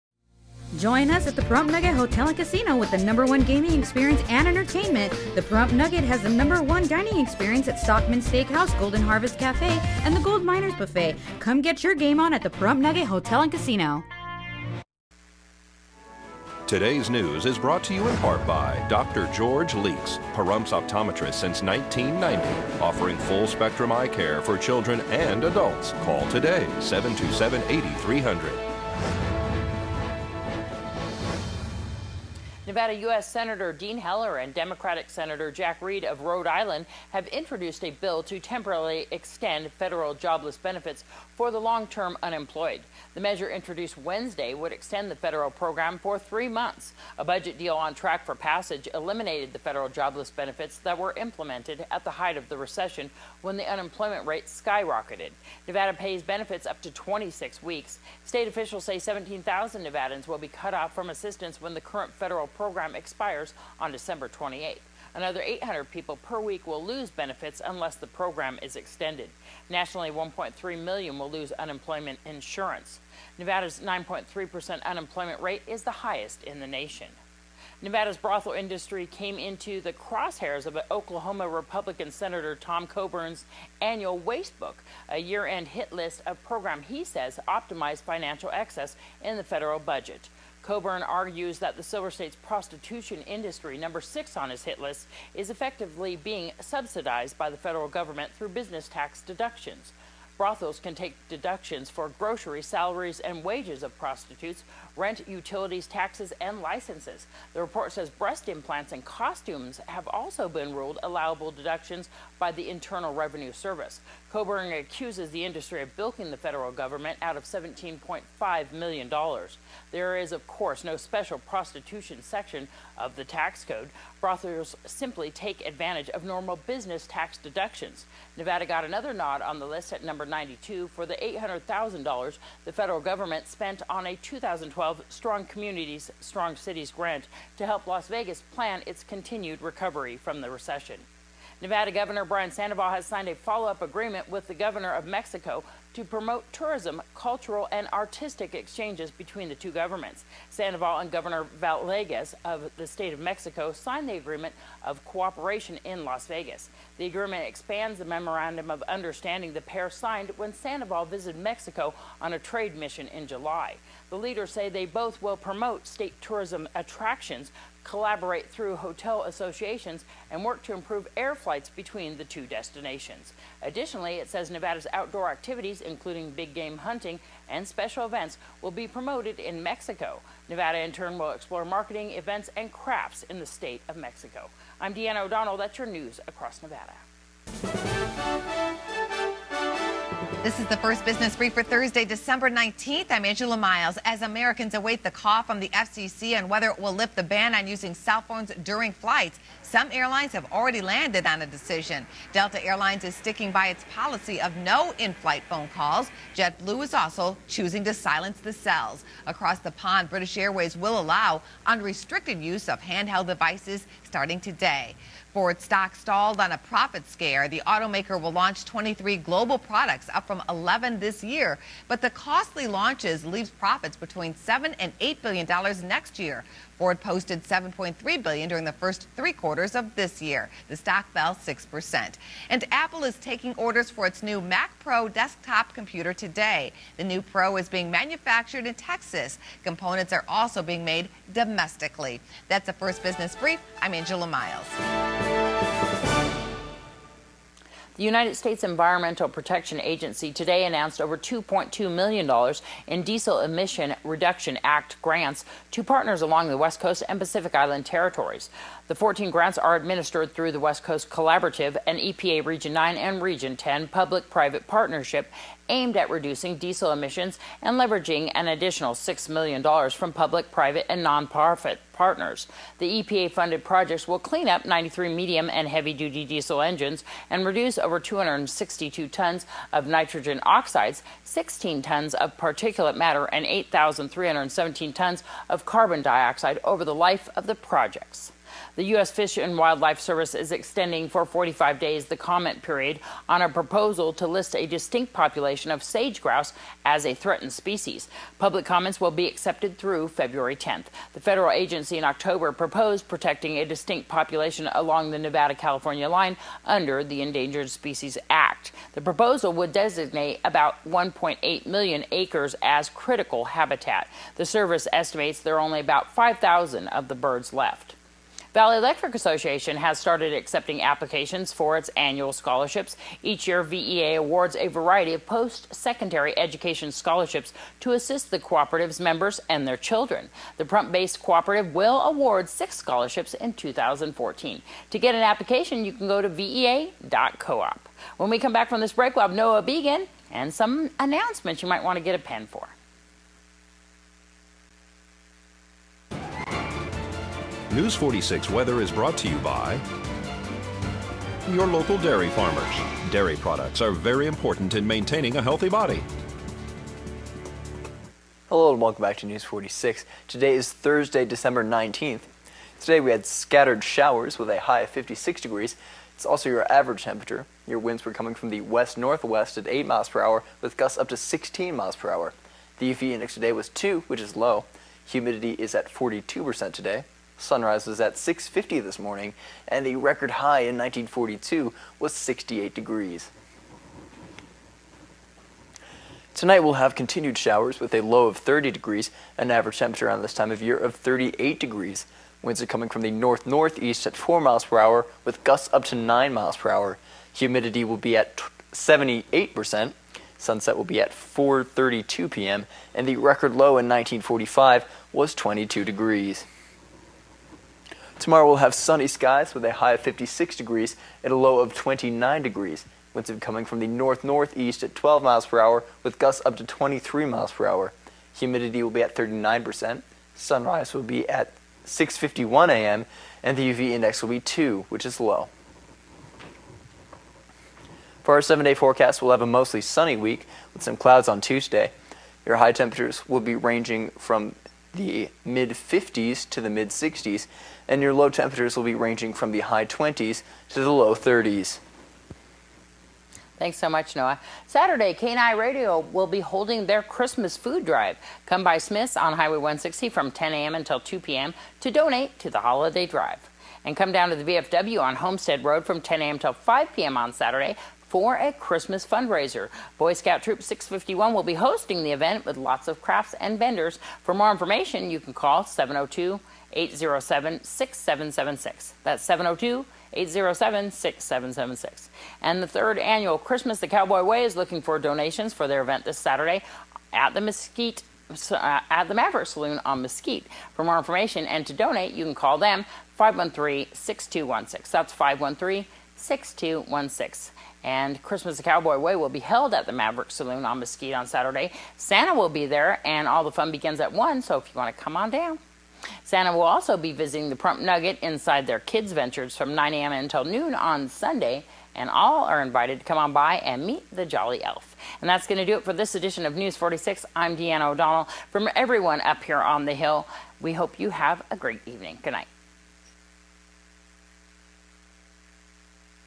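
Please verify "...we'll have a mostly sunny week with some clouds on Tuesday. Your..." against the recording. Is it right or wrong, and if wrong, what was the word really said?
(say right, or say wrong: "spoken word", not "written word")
right.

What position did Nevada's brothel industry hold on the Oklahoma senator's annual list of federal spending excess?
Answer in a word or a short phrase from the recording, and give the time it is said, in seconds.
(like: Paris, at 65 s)
number six, at 93 s.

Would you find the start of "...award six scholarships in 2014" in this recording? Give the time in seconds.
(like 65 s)
332 s.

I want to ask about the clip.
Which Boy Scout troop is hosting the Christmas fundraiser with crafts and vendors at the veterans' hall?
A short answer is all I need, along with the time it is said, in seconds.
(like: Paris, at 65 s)
Troop 651, at 460 s.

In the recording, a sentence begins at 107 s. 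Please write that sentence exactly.
The report says breast implants and costumes have also been ruled allowable deductions by the Internal Revenue Service.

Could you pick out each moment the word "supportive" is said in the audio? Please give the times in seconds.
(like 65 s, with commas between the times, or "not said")
not said.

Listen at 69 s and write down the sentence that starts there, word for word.
Nationally, 1.3 million will lose unemployment insurance.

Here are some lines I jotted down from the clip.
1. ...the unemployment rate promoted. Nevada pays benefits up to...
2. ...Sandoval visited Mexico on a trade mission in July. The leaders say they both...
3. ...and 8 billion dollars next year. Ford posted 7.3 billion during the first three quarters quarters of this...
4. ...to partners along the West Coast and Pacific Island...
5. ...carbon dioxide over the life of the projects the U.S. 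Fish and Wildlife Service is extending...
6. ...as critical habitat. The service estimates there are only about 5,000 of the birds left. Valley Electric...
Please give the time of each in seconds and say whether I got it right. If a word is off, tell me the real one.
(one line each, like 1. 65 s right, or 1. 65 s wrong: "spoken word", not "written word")
1. 53 s wrong: "skyrocketed", not "promoted"
2. 160 s right
3. 224 s right
4. 255 s right
5. 285 s right
6. 312 s right.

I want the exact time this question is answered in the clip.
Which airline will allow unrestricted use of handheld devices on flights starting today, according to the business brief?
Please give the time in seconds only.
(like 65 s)
210 s.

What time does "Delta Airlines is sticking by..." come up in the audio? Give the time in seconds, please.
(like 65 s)
202 s.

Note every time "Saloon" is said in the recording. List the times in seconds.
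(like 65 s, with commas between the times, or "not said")
479 s, 490 s.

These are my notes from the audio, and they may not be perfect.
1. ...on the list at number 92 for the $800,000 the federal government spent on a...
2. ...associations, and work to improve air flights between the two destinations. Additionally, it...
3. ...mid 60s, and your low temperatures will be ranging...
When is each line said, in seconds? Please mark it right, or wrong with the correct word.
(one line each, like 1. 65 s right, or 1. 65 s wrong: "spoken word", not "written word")
1. 129 s right
2. 169 s right
3. 436 s right.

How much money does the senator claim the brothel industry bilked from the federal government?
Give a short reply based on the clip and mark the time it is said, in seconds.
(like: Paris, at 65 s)
$17.5 million, at 117 s.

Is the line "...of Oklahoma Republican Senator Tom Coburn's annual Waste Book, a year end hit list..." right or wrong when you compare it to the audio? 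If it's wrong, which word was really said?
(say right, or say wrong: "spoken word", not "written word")
right.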